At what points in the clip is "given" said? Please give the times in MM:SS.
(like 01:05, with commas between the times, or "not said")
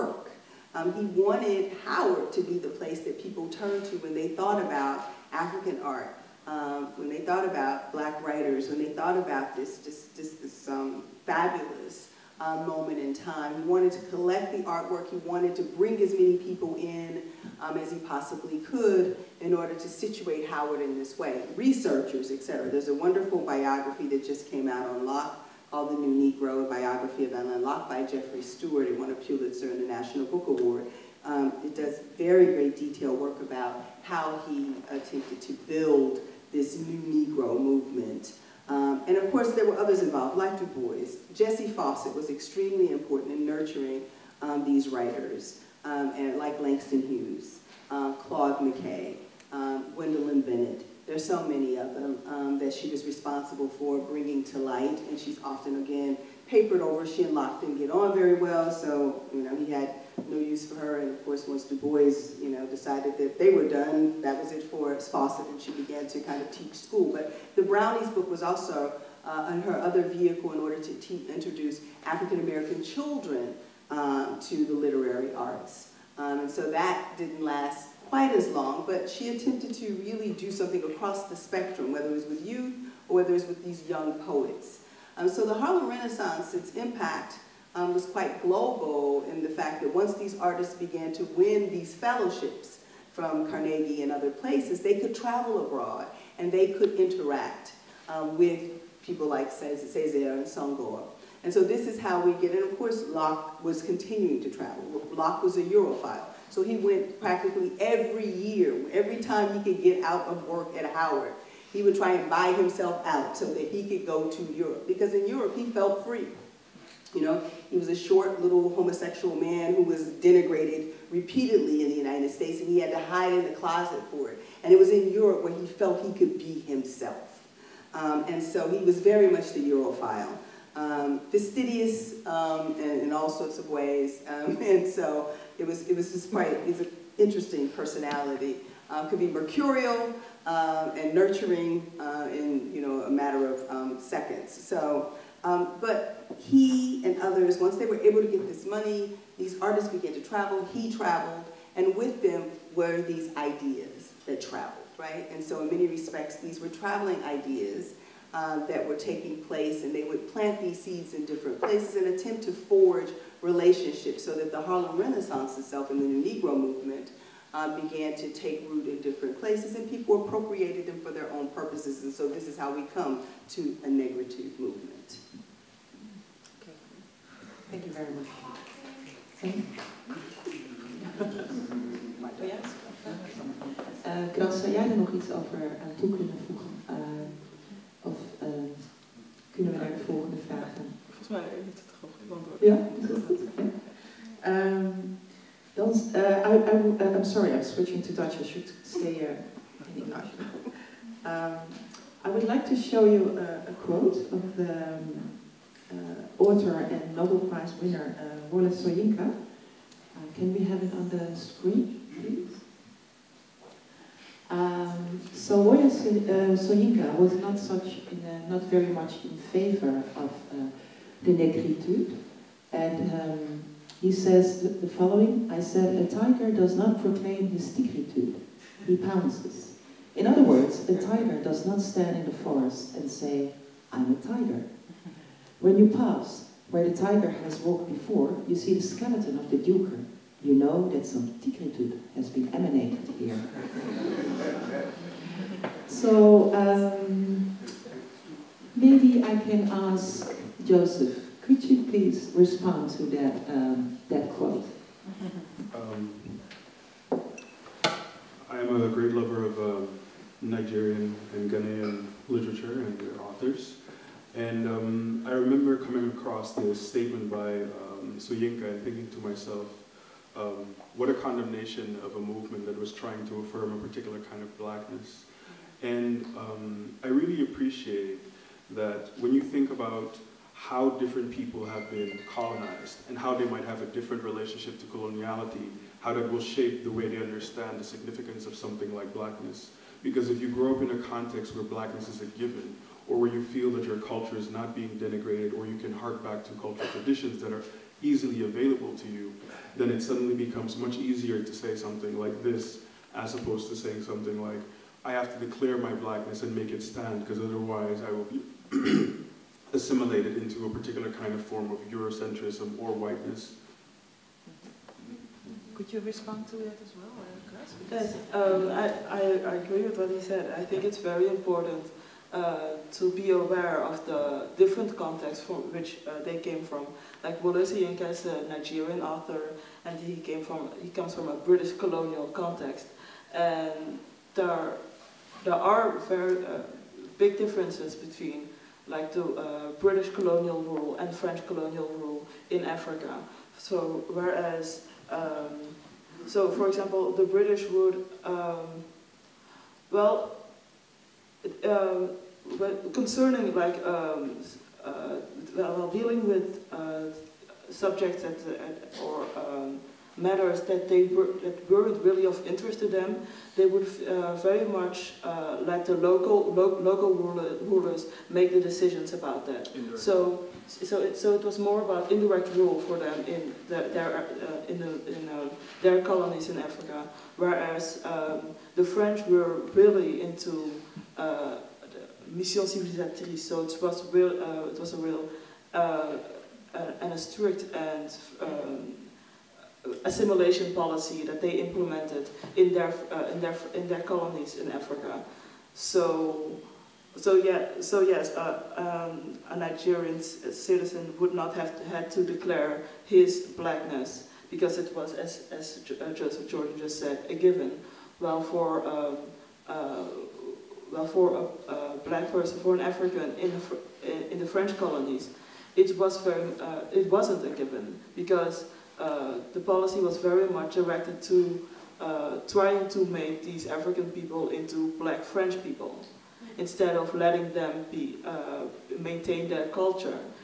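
04:52, 06:47, 06:57.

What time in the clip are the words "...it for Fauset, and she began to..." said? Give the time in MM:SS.
01:04.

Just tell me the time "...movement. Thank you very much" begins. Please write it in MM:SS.
02:54.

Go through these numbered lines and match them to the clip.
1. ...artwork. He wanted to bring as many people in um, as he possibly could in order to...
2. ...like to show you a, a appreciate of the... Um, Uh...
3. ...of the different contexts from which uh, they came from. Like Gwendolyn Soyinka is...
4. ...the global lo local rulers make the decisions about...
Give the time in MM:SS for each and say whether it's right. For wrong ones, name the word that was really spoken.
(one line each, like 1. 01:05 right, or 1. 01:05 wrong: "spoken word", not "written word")
1. 00:14 right
2. 03:22 wrong: "quote", not "appreciate"
3. 05:23 wrong: "Wole", not "Gwendolyn"
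4. 06:05 wrong: "local", not "global".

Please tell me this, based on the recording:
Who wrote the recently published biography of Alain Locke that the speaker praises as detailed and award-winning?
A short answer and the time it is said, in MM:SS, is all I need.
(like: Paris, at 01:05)
Jeffrey Stewart, at 00:28.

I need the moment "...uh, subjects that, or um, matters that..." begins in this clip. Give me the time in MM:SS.
05:56.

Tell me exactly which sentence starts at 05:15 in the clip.
Could you respond to that as well, Yes, um, I, I, I agree with what he said.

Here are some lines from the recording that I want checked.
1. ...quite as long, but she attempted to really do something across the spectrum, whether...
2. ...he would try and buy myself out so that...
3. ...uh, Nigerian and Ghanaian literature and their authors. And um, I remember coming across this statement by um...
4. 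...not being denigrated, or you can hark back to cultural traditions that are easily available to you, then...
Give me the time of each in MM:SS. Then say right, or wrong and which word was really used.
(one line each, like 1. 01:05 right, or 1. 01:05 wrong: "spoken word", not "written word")
1. 01:18 right
2. 01:51 wrong: "himself", not "myself"
3. 04:19 right
4. 04:54 right.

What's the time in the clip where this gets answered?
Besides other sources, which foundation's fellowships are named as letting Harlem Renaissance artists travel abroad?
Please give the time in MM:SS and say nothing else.
01:33.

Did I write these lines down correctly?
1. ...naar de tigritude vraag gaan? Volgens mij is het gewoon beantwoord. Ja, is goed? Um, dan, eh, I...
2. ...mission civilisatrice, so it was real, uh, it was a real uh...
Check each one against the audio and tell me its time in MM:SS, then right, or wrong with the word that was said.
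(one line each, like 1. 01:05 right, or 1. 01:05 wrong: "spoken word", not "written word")
1. 03:09 wrong: "volgende", not "tigritude"
2. 06:22 right.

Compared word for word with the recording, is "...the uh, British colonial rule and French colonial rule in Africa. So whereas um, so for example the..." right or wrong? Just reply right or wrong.
right.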